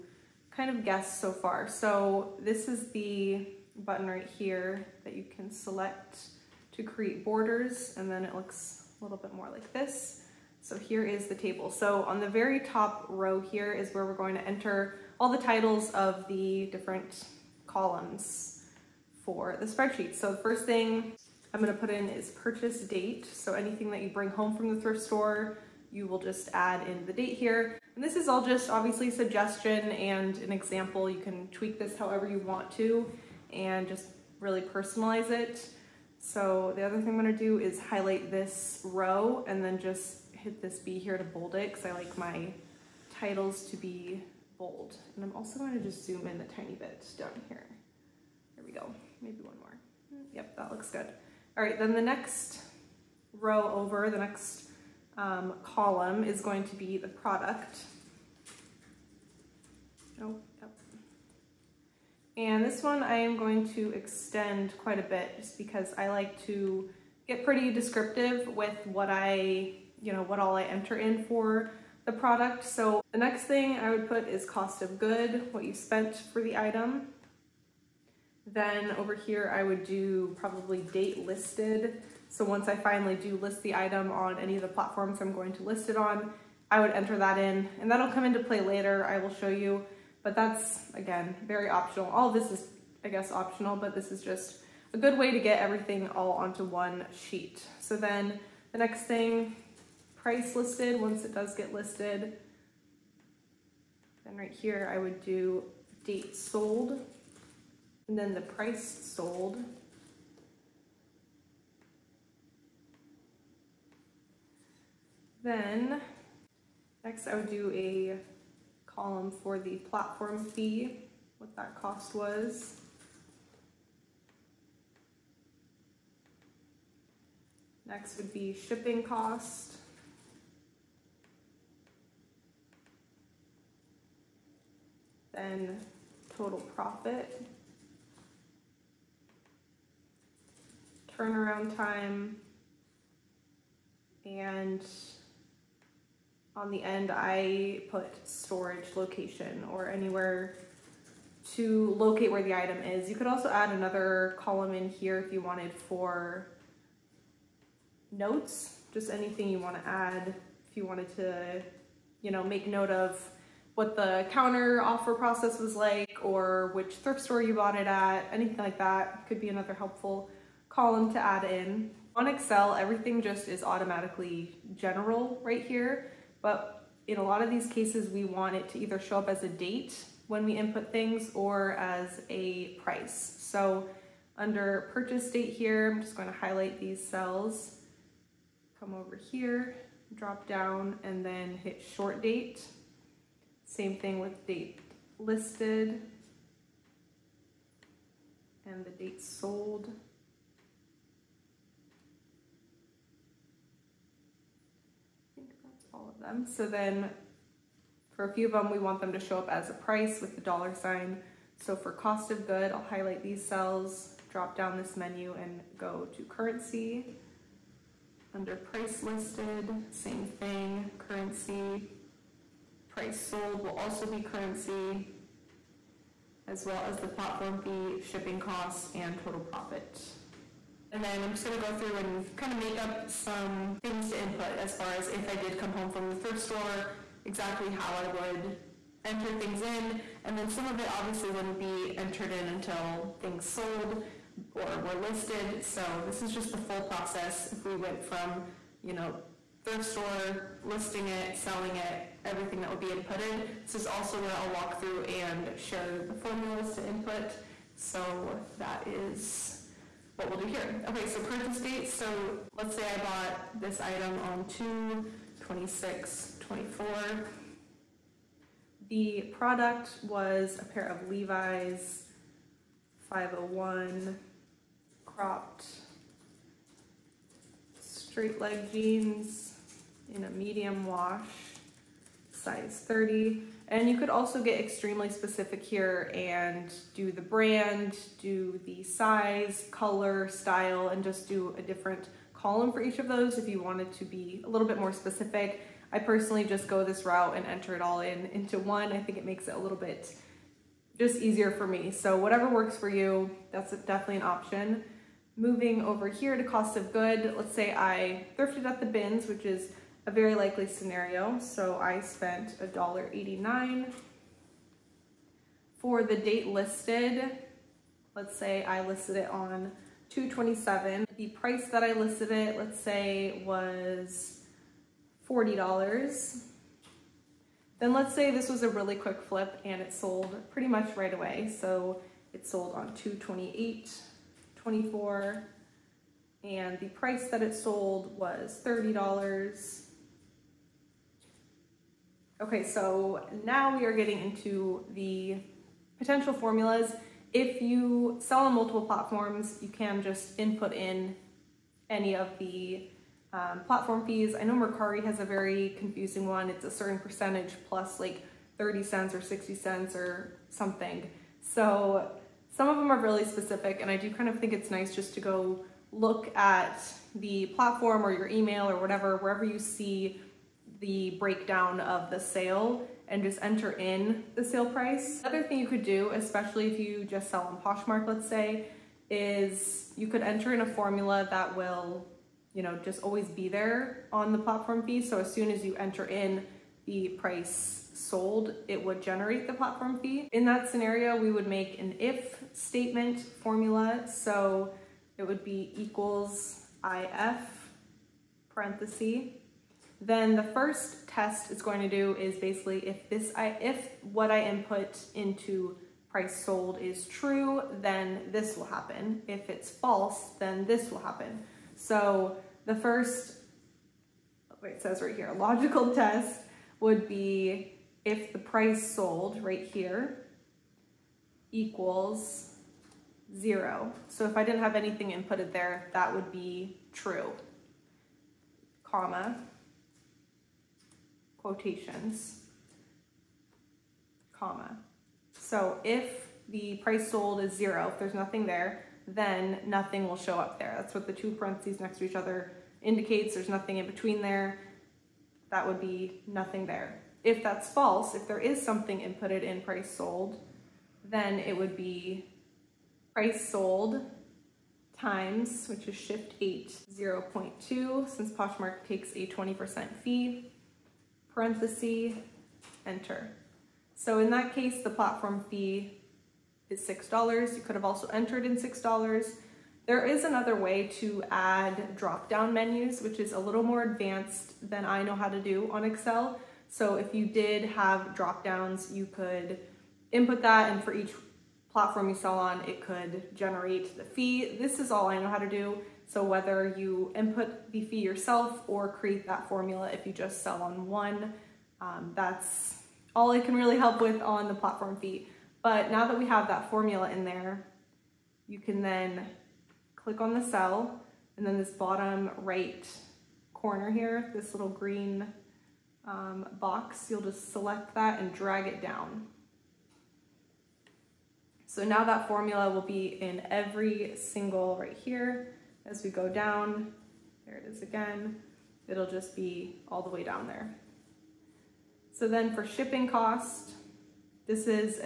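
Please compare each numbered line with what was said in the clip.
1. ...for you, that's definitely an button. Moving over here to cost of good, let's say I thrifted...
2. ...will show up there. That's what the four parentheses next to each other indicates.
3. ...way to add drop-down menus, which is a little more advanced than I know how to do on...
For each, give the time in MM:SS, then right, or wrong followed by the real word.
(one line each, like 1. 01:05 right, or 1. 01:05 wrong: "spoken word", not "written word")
1. 05:02 wrong: "option", not "button"
2. 07:20 wrong: "two", not "four"
3. 07:50 right.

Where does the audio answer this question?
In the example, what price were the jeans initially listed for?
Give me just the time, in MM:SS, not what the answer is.
05:25.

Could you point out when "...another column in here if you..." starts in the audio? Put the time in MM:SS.
02:33.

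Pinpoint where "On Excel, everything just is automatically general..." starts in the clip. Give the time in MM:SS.
02:52.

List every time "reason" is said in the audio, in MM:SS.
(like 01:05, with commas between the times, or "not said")
not said.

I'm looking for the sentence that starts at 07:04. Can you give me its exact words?
So if I didn't have anything inputted there, that would be true, comma, quotations, comma.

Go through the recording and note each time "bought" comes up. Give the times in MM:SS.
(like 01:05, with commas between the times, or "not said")
02:47, 04:22.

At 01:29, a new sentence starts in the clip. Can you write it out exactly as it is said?
I will show you but that's, again, very optional.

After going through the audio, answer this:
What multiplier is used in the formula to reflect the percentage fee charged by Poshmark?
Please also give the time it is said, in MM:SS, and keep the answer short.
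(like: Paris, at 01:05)
0.2, at 07:36.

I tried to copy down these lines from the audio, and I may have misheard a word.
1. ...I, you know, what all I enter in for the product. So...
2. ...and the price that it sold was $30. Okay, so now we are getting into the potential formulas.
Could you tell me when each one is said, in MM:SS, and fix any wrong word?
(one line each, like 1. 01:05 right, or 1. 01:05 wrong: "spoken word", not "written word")
1. 01:09 right
2. 05:36 right.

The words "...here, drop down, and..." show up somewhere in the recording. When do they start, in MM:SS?
03:09.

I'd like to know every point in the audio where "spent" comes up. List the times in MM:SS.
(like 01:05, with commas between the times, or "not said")
01:15, 05:11.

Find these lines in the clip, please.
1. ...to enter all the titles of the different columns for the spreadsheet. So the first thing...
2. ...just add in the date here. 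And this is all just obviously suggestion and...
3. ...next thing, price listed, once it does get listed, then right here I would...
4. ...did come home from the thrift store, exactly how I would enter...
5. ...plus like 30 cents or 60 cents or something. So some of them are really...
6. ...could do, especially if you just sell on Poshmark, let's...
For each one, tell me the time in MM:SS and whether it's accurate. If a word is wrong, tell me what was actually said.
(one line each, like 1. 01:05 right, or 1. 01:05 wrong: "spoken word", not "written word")
1. 00:14 right
2. 00:26 right
3. 01:38 right
4. 03:55 right
5. 05:57 right
6. 06:15 right.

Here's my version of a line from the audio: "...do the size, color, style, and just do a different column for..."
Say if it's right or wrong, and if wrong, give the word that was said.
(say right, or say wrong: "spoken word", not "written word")
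right.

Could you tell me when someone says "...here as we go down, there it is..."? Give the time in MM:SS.
08:34.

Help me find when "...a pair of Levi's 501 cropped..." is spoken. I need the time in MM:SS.
04:30.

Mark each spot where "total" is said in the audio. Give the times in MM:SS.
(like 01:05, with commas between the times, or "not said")
02:16, 03:49.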